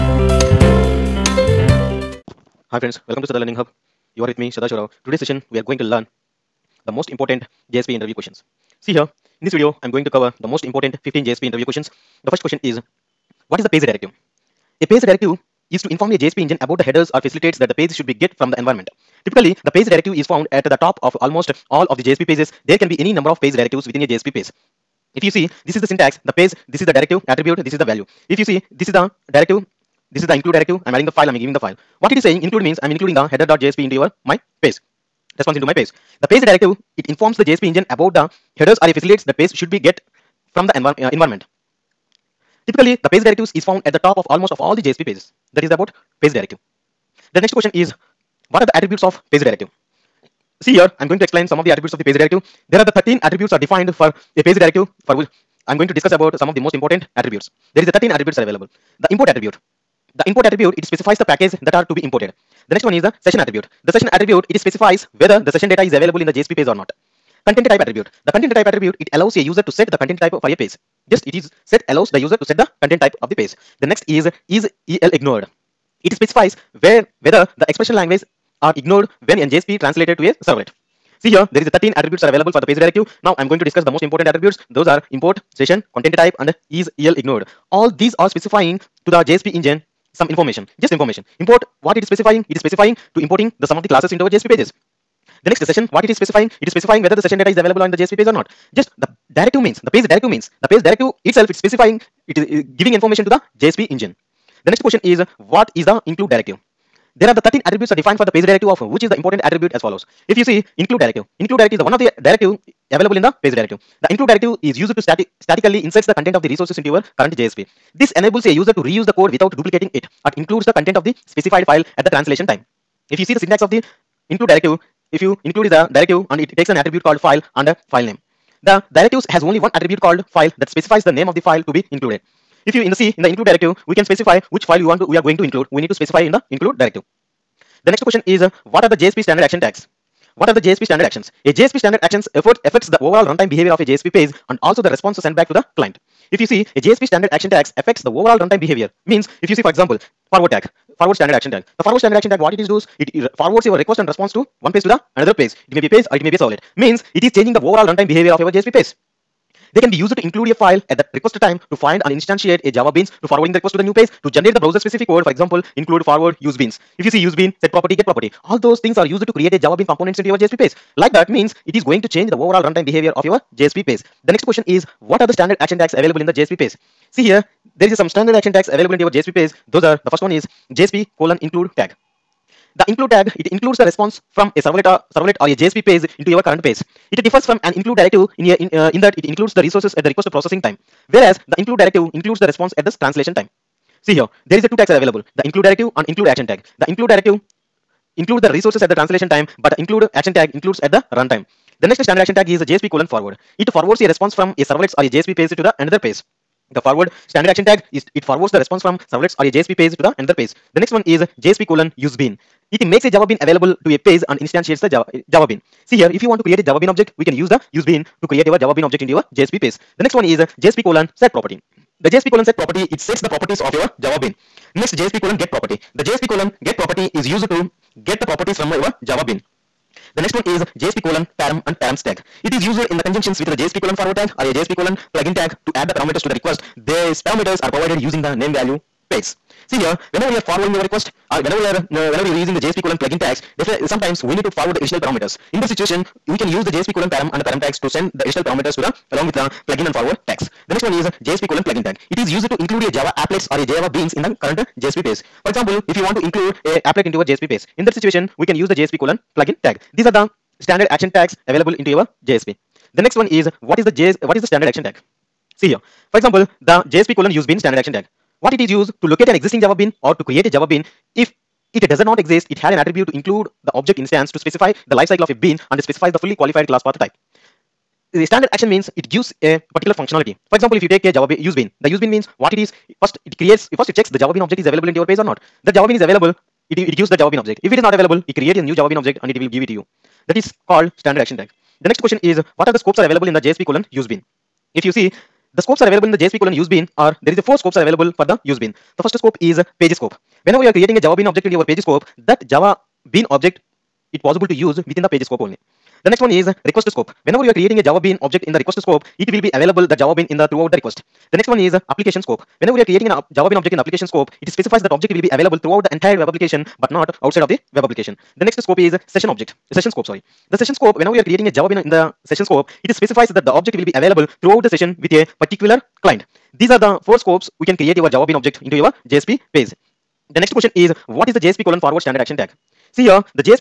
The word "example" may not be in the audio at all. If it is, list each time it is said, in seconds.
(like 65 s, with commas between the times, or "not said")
149 s, 165 s, 255 s, 266 s, 280 s.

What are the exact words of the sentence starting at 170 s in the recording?
Like that means it is going to change the overall runtime behavior of your JSP page.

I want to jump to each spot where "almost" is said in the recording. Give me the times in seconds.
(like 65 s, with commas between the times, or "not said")
21 s, 44 s.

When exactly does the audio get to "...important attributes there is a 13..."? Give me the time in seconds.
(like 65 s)
56 s.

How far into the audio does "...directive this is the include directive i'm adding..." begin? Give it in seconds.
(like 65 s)
29 s.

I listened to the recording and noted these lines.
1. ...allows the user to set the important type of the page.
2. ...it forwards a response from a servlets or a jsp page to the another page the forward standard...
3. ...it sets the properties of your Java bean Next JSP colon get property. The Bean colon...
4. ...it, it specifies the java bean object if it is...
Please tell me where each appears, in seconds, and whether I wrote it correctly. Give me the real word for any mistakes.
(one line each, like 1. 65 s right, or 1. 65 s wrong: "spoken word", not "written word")
1. 71 s wrong: "content", not "important"
2. 203 s right
3. 222 s wrong: "JSP", not "Bean"
4. 286 s wrong: "gives", not "specifies".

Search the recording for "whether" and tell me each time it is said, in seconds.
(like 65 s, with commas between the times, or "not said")
65 s, 77 s, 97 s.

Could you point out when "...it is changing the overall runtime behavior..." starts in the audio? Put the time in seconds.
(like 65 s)
157 s.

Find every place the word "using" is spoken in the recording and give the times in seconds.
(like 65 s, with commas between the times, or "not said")
237 s, 242 s.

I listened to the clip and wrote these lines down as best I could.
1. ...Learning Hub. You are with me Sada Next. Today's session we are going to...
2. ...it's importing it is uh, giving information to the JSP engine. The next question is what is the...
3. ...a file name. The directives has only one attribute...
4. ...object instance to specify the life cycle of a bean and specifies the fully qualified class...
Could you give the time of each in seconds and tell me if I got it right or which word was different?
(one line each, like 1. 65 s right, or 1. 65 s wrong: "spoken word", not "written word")
1. 3 s wrong: "Shorao", not "Next"
2. 101 s wrong: "specifying", not "importing"
3. 127 s right
4. 273 s right.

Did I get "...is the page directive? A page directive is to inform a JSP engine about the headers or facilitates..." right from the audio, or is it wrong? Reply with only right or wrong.
right.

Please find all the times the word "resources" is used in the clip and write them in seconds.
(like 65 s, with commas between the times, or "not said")
116 s, 189 s, 198 s.